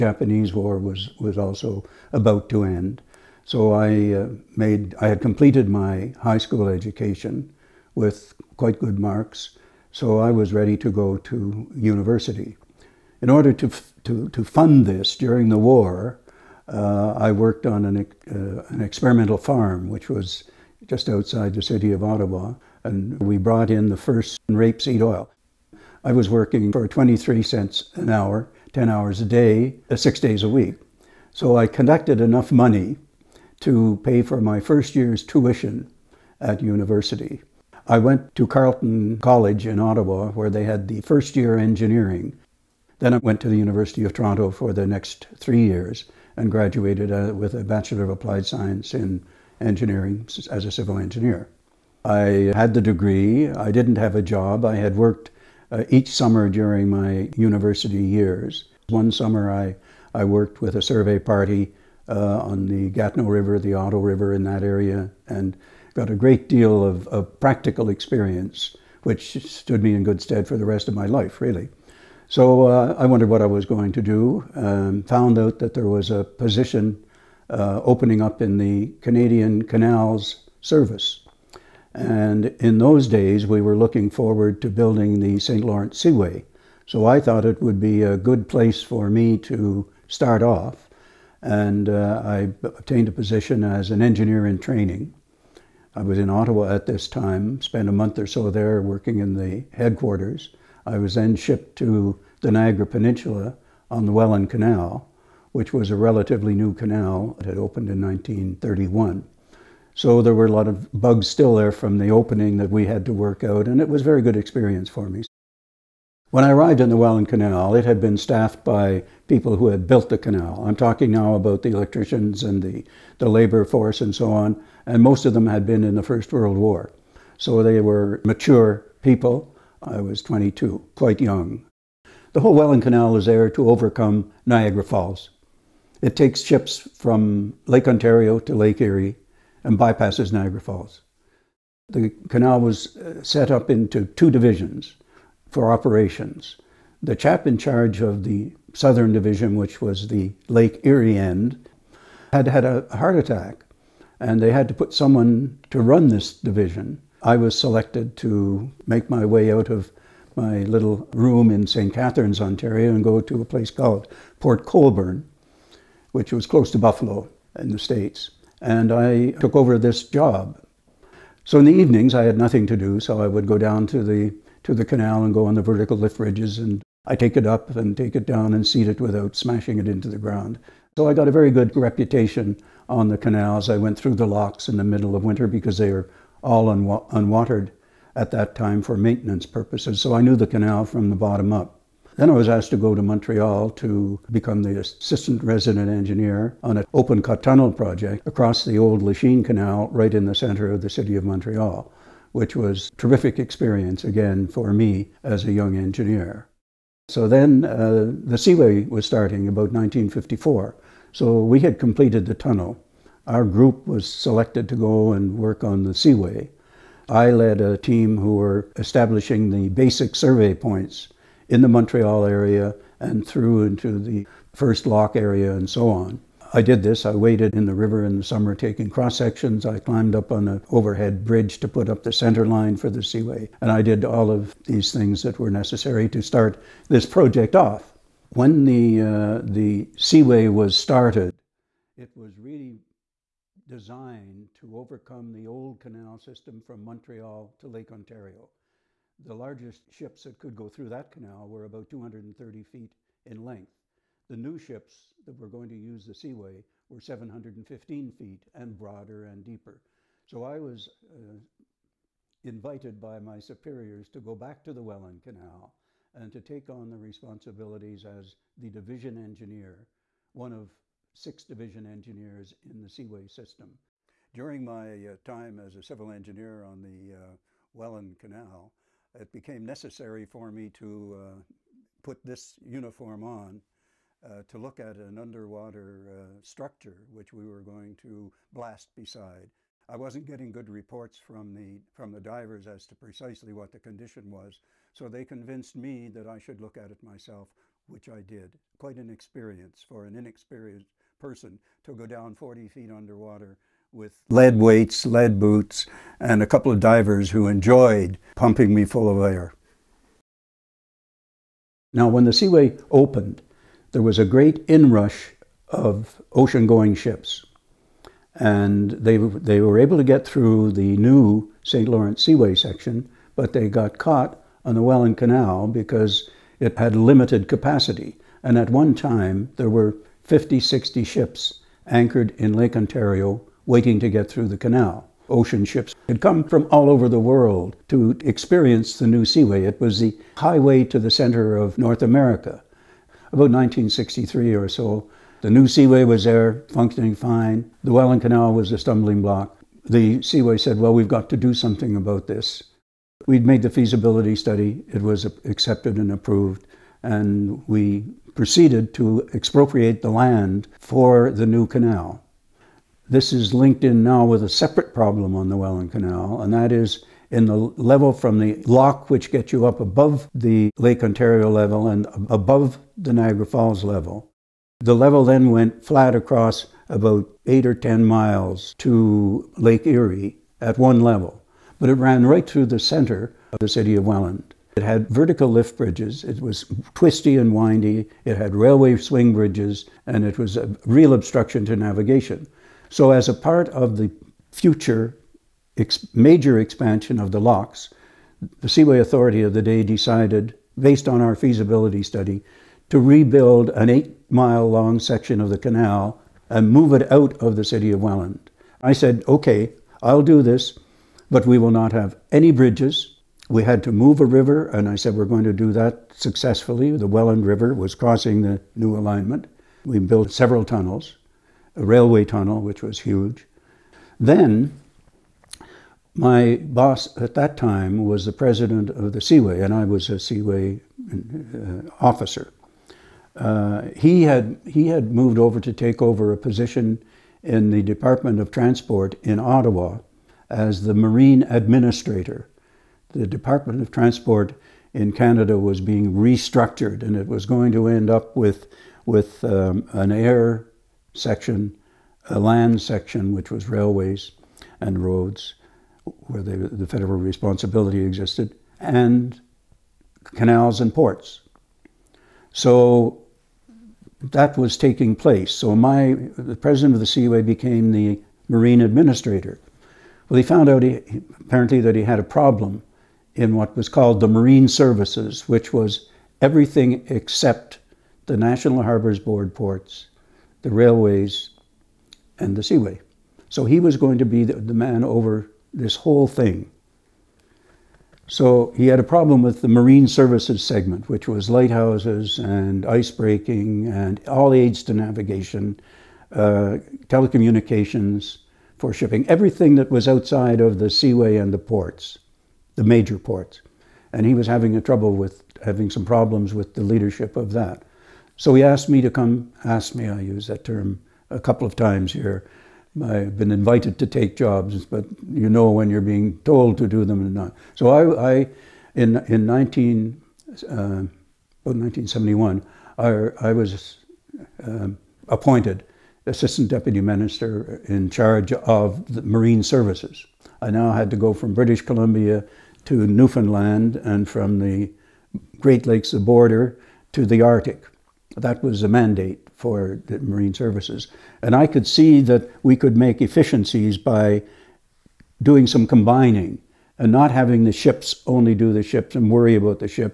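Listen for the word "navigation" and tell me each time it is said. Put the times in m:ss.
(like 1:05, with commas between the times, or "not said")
6:31, 8:14.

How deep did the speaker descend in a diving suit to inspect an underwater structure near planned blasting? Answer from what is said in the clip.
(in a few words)
40 feet.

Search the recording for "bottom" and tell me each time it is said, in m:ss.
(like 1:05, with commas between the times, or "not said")
3:11.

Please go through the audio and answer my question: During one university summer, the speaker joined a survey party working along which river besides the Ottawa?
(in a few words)
Gatineau River.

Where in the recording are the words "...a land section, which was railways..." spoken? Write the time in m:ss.
7:32.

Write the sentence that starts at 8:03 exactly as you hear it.
So he was going to be the, the man over this whole thing.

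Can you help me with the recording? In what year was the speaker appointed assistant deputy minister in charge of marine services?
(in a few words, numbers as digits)
1971.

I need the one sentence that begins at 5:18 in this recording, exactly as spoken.
And they, they were able to get through the new St.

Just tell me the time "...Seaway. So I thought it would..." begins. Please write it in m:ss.
1:25.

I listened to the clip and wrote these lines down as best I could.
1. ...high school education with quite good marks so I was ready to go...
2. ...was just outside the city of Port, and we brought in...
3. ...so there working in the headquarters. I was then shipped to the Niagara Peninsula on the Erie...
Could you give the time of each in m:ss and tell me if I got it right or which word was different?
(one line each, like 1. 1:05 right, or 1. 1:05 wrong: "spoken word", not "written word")
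1. 0:06 right
2. 0:20 wrong: "Ottawa", not "Port"
3. 1:38 wrong: "Welland", not "Erie".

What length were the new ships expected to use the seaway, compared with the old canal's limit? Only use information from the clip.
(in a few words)
715 feet.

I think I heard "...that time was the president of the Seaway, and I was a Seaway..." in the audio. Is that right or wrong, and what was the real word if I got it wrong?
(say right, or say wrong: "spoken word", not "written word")
right.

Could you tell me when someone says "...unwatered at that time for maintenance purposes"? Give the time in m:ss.
3:07.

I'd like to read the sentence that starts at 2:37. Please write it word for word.
I was selected to make my way out of my little room in St.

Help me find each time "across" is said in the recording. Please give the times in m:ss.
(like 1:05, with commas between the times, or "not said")
3:18, 6:16.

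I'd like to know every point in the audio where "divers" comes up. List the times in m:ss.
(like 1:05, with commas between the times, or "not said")
4:52, 5:06.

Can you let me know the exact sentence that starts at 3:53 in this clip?
And I did all of these things that were necessary to start this project off.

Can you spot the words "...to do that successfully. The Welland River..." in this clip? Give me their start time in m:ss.
6:55.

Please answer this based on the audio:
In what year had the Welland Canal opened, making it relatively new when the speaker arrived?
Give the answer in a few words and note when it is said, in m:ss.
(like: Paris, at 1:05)
1931, at 1:48.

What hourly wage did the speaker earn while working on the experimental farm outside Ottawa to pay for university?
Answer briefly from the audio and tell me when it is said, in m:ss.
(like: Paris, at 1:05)
23 cents, at 0:26.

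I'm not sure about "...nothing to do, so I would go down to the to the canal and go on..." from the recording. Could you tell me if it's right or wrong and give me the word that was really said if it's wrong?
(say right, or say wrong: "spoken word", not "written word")
right.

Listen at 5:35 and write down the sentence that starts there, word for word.
Ocean ships had come from all over the world to experience the new seaway.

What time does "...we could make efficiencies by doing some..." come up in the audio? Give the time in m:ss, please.
9:02.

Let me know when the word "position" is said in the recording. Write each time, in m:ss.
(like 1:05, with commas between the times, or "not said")
1:16, 1:33, 7:16.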